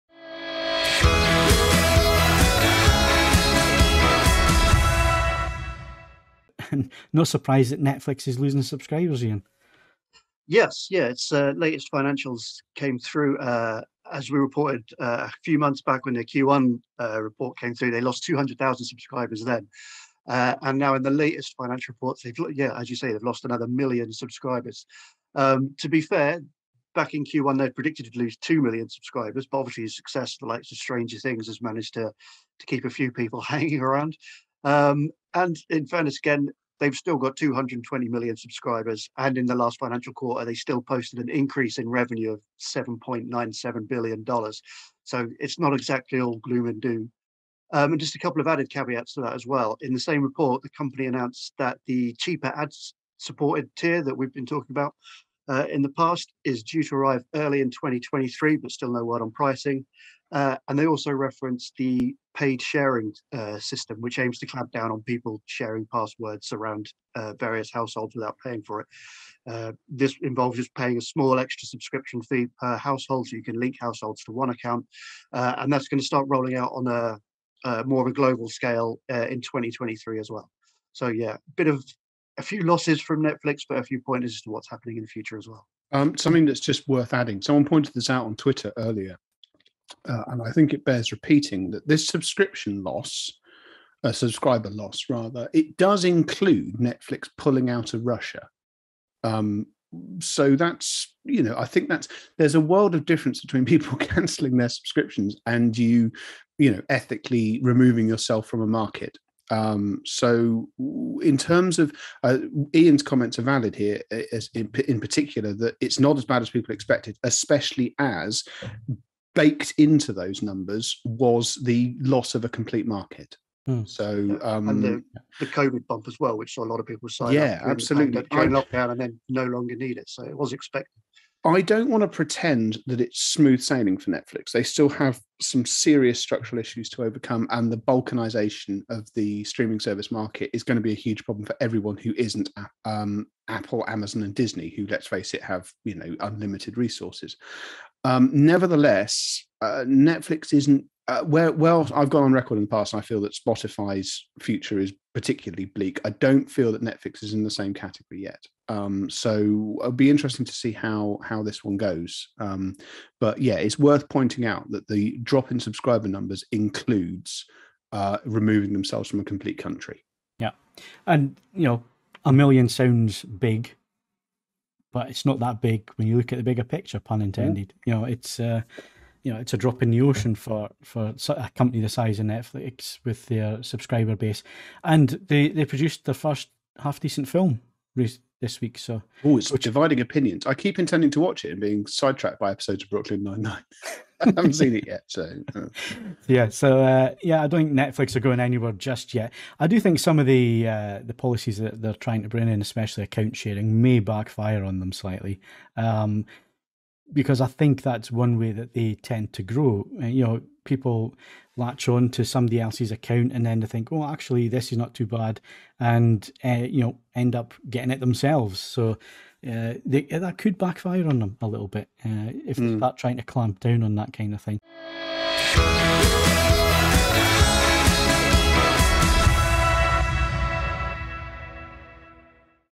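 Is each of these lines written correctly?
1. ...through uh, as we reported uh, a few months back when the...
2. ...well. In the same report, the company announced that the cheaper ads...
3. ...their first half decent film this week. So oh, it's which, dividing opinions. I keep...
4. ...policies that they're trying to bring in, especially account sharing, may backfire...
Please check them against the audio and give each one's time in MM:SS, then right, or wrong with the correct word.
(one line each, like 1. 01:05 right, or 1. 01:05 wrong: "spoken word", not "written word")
1. 00:12 right
2. 00:49 right
3. 03:06 right
4. 03:21 right.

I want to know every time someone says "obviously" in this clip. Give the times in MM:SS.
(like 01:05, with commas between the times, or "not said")
00:29.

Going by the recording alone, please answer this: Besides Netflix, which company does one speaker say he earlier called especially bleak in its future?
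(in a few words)
Spotify.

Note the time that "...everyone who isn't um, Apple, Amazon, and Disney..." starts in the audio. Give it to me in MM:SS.
02:21.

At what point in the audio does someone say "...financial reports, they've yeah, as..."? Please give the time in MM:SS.
00:21.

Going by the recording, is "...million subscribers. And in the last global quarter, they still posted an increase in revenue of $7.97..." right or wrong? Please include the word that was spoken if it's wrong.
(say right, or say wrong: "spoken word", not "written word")
wrong: "financial", not "global".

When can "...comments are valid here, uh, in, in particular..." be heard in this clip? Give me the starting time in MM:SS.
01:53.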